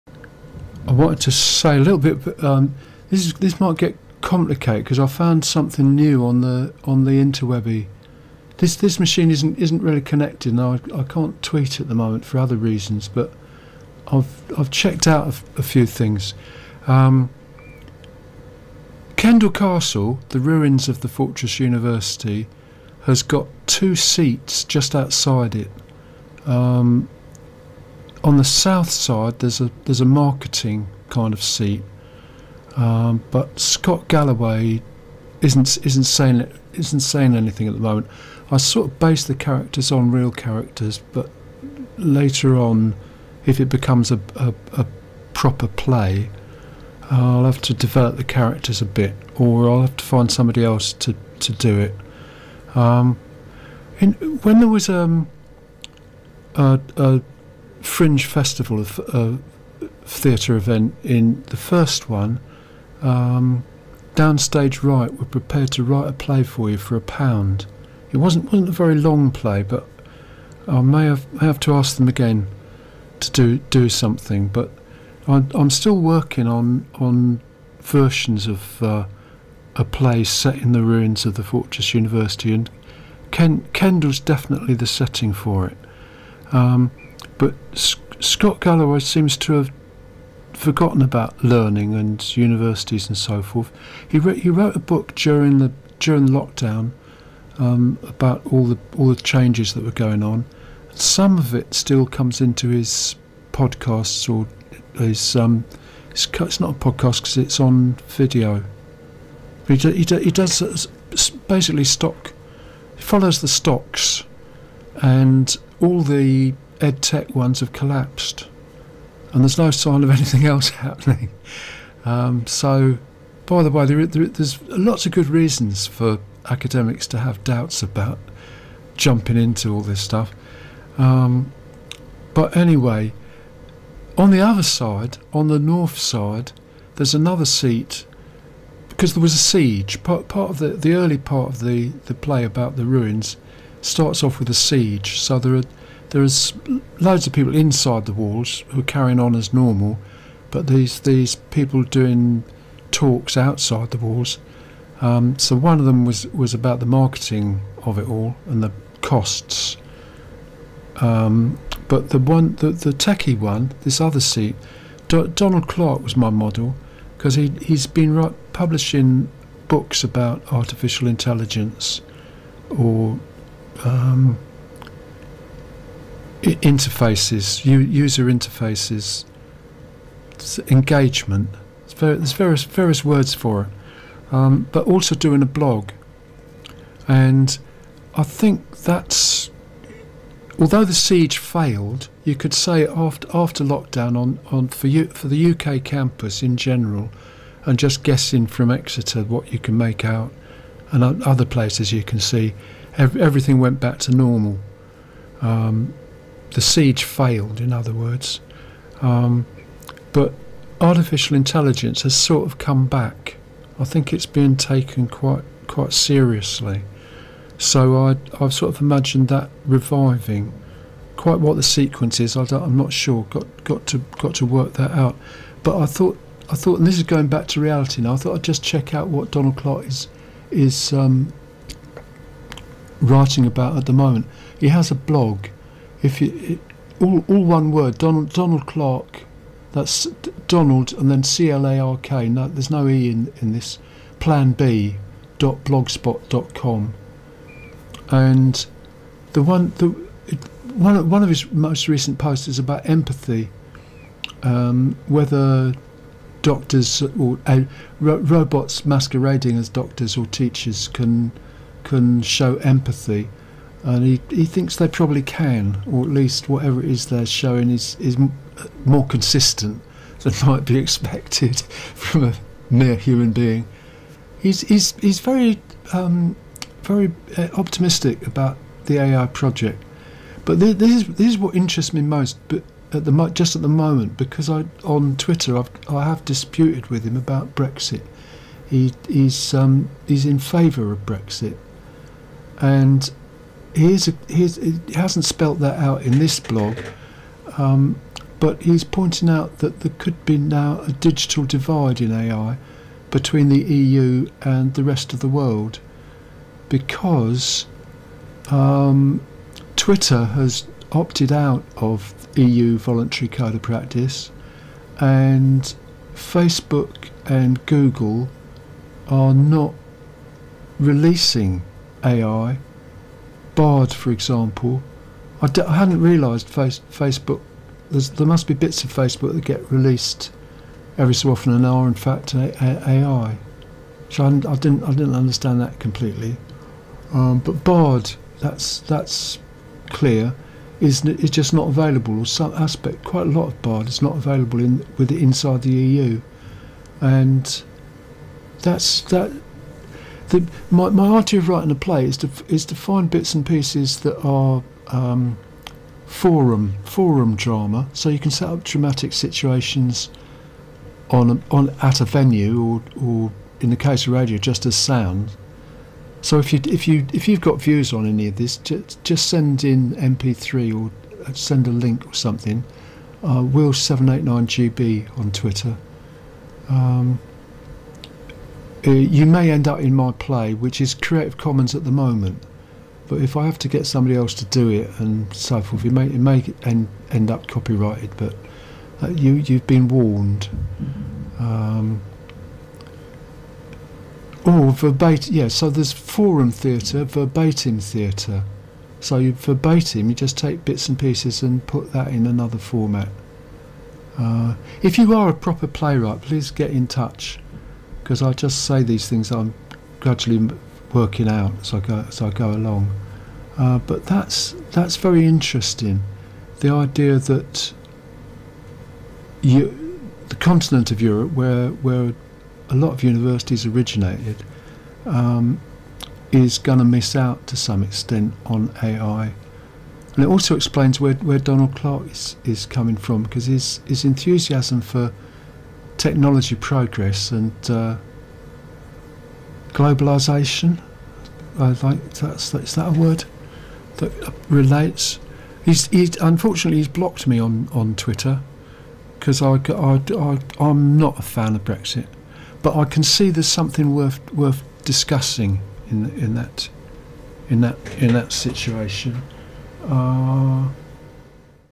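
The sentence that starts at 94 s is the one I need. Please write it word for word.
He, he wrote a book during the during lockdown um, about all the all the changes that were going on.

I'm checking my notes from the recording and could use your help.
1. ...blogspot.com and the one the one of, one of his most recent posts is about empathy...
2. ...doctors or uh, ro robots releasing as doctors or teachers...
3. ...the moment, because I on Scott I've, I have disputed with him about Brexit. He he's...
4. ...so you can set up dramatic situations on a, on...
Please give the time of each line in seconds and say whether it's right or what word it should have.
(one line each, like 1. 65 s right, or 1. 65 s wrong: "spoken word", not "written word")
1. 245 s right
2. 256 s wrong: "masquerading", not "releasing"
3. 283 s wrong: "Twitter", not "Scott"
4. 357 s right.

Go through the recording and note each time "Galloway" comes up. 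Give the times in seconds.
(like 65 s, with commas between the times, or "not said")
34 s, 88 s.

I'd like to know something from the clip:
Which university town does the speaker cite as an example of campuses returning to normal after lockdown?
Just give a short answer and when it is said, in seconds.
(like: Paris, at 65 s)
Exeter, at 198 s.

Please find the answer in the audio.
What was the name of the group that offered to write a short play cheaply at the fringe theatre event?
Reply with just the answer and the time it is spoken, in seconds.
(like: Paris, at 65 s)
Downstage Right, at 64 s.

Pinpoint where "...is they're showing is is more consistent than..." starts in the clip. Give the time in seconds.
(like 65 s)
266 s.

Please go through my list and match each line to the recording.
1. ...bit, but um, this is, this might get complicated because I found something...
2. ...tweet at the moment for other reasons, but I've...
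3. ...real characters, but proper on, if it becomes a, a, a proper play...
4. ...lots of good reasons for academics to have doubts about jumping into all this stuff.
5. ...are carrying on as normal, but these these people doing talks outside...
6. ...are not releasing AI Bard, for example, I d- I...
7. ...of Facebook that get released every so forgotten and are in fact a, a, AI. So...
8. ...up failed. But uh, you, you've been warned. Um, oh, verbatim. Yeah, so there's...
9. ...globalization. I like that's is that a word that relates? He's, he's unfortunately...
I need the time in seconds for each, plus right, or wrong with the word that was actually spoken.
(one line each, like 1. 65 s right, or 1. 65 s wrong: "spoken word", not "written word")
1. 1 s right
2. 11 s right
3. 40 s wrong: "later", not "proper"
4. 124 s right
5. 148 s right
6. 319 s right
7. 328 s wrong: "often", not "forgotten"
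8. 387 s wrong: "copyrighted", not "failed"
9. 439 s right.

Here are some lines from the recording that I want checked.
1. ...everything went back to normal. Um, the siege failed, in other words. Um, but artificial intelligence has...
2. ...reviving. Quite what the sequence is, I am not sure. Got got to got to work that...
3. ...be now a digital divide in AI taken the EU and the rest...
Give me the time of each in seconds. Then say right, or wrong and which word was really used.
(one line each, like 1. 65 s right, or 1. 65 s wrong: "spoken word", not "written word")
1. 202 s right
2. 219 s right
3. 300 s wrong: "between", not "taken".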